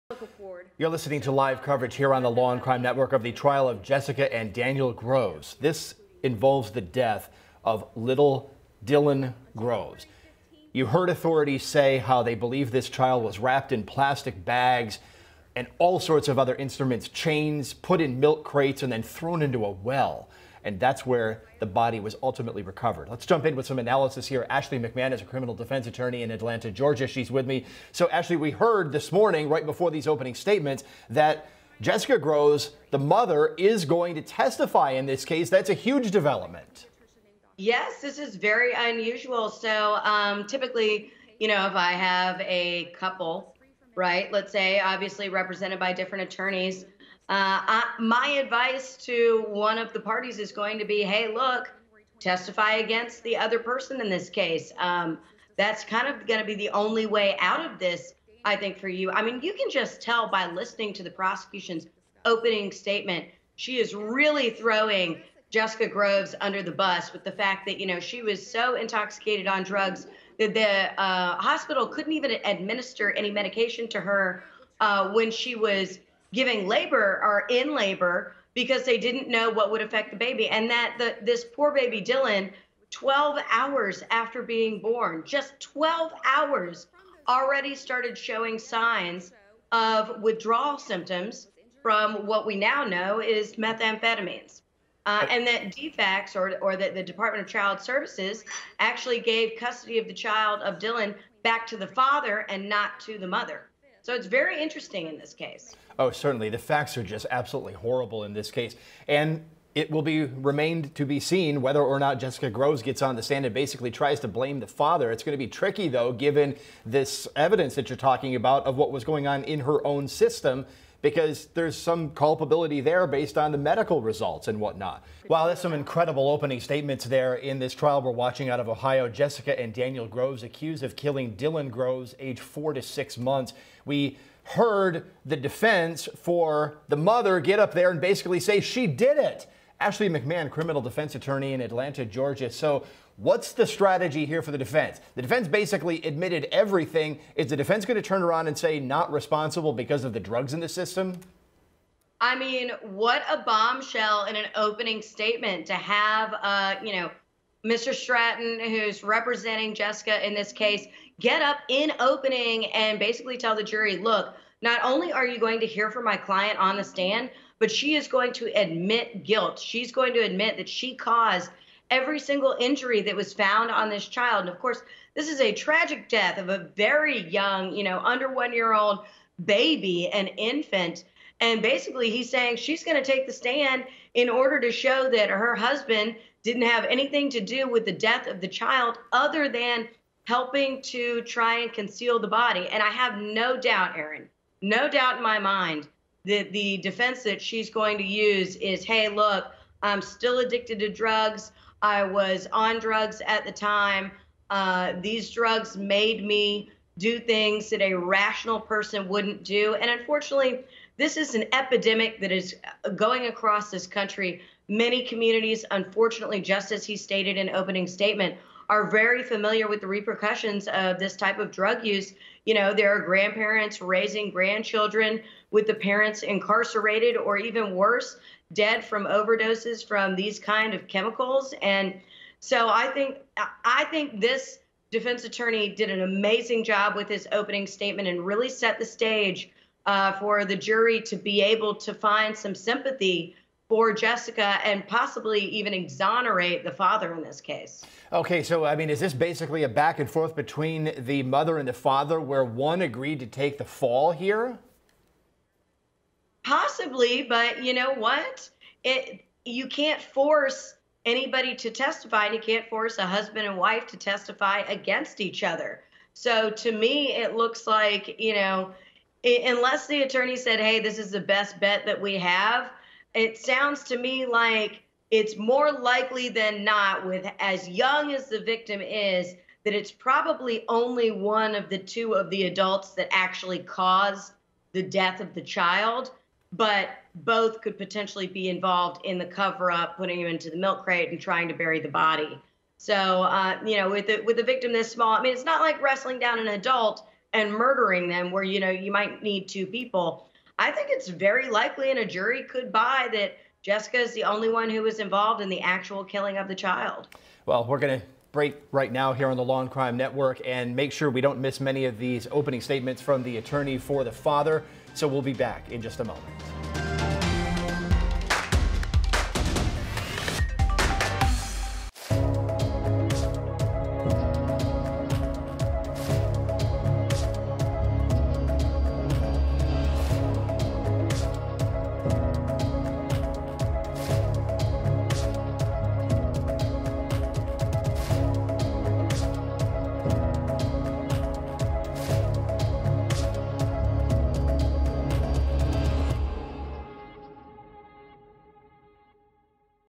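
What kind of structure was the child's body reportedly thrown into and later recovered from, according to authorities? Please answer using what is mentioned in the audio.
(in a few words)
A well.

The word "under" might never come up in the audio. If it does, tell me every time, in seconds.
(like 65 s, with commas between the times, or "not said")
66 s, 177 s.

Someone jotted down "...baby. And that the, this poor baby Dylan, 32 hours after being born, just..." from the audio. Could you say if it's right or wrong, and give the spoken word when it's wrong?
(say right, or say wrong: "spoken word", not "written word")
wrong: "12", not "32".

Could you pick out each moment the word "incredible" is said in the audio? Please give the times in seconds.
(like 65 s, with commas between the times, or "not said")
125 s.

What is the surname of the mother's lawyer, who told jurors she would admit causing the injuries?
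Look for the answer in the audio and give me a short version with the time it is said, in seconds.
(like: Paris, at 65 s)
Stratton, at 157 s.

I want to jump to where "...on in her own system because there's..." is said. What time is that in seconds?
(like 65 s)
119 s.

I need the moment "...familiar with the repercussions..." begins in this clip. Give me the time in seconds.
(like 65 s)
219 s.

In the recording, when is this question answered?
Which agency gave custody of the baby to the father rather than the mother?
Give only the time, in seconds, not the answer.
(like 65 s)
97 s.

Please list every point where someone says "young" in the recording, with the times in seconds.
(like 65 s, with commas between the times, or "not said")
177 s, 277 s.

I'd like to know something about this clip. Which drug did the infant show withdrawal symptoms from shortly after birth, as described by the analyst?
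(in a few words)
Methamphetamines.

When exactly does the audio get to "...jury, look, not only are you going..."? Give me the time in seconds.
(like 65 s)
163 s.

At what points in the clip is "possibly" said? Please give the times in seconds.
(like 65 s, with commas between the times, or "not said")
244 s, 256 s.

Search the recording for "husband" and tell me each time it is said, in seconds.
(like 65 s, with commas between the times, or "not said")
185 s, 263 s.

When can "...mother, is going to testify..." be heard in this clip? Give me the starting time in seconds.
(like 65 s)
32 s.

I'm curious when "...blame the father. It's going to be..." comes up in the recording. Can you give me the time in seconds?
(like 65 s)
114 s.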